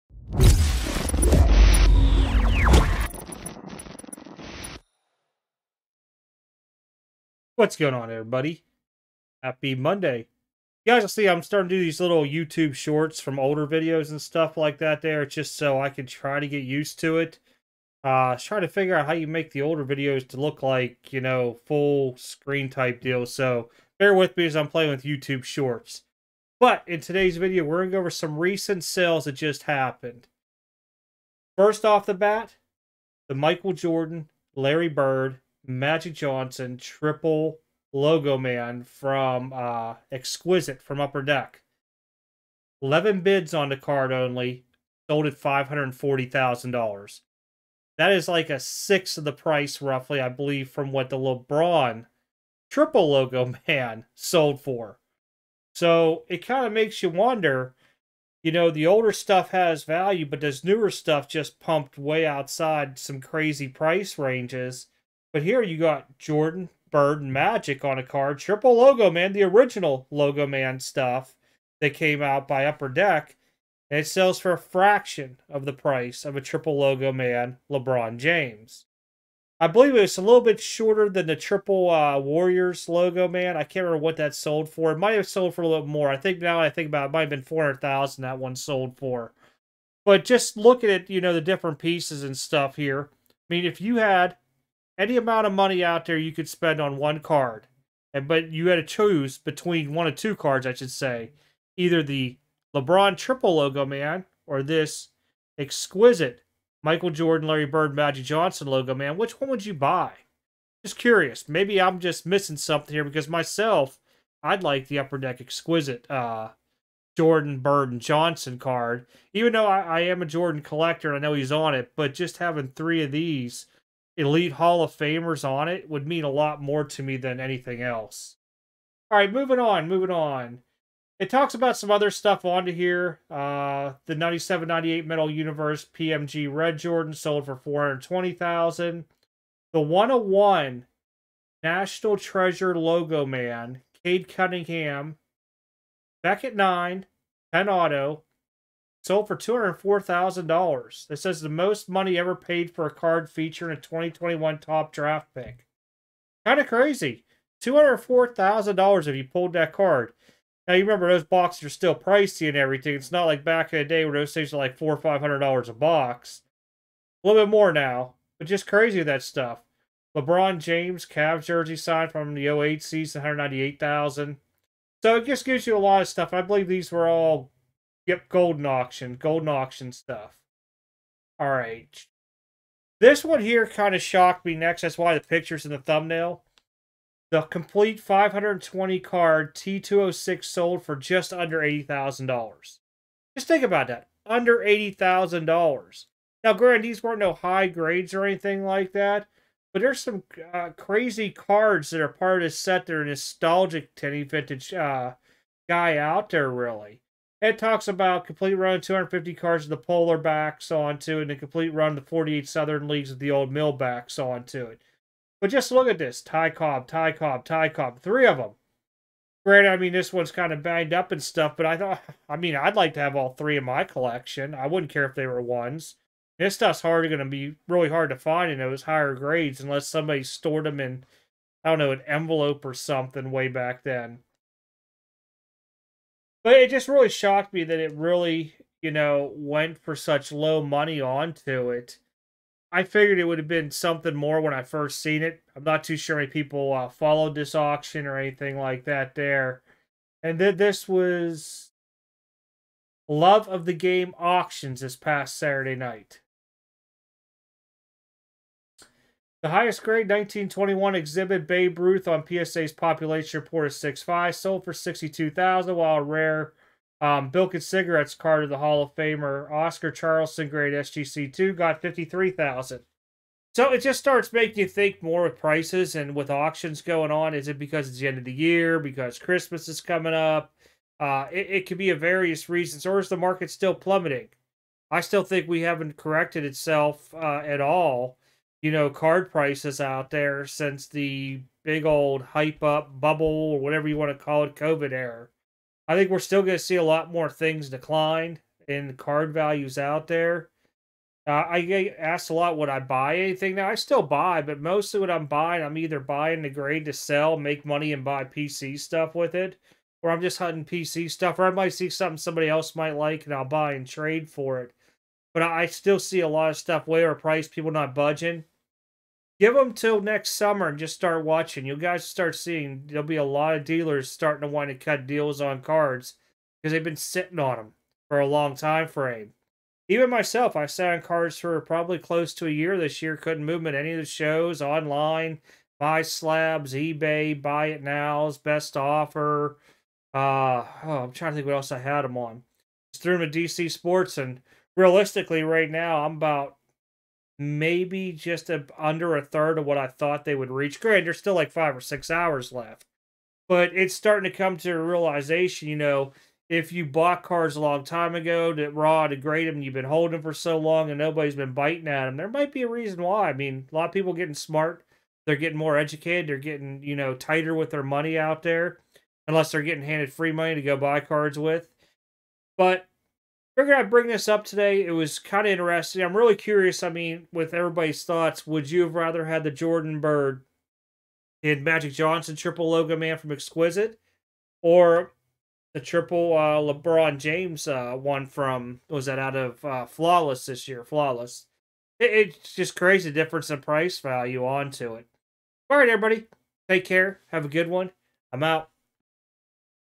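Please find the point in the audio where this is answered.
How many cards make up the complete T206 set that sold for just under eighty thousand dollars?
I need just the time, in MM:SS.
03:08.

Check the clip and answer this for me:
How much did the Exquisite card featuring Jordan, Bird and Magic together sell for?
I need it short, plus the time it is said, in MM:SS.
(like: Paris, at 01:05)
$540,000, at 00:45.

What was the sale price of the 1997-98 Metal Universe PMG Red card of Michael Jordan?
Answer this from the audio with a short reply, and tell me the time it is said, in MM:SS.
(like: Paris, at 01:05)
420000, at 02:17.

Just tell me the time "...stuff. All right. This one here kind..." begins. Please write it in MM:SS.
02:59.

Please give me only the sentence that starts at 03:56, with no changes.
But it just really shocked me that it really, you know, went for such low money onto it.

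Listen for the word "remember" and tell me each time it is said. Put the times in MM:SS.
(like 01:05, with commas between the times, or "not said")
01:23, 02:40.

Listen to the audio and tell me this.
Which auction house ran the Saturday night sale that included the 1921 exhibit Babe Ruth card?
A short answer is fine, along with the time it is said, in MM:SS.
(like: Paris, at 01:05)
Love of the Game, at 04:13.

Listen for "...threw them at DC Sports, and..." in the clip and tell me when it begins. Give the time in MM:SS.
05:43.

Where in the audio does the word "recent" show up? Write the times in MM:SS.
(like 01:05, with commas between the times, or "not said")
00:28.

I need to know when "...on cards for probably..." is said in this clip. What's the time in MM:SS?
05:30.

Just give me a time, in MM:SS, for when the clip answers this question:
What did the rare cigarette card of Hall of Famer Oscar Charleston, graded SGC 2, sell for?
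04:31.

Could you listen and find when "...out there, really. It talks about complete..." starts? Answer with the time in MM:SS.
03:25.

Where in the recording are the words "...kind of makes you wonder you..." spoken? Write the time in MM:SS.
00:56.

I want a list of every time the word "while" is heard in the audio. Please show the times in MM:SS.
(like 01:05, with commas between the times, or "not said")
04:25.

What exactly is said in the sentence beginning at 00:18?
Uh, try to figure out how you make the older videos to look like, you know, full screen type deal.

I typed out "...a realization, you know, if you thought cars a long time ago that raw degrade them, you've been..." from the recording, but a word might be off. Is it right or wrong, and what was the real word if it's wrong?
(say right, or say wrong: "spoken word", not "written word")
wrong: "bought", not "thought".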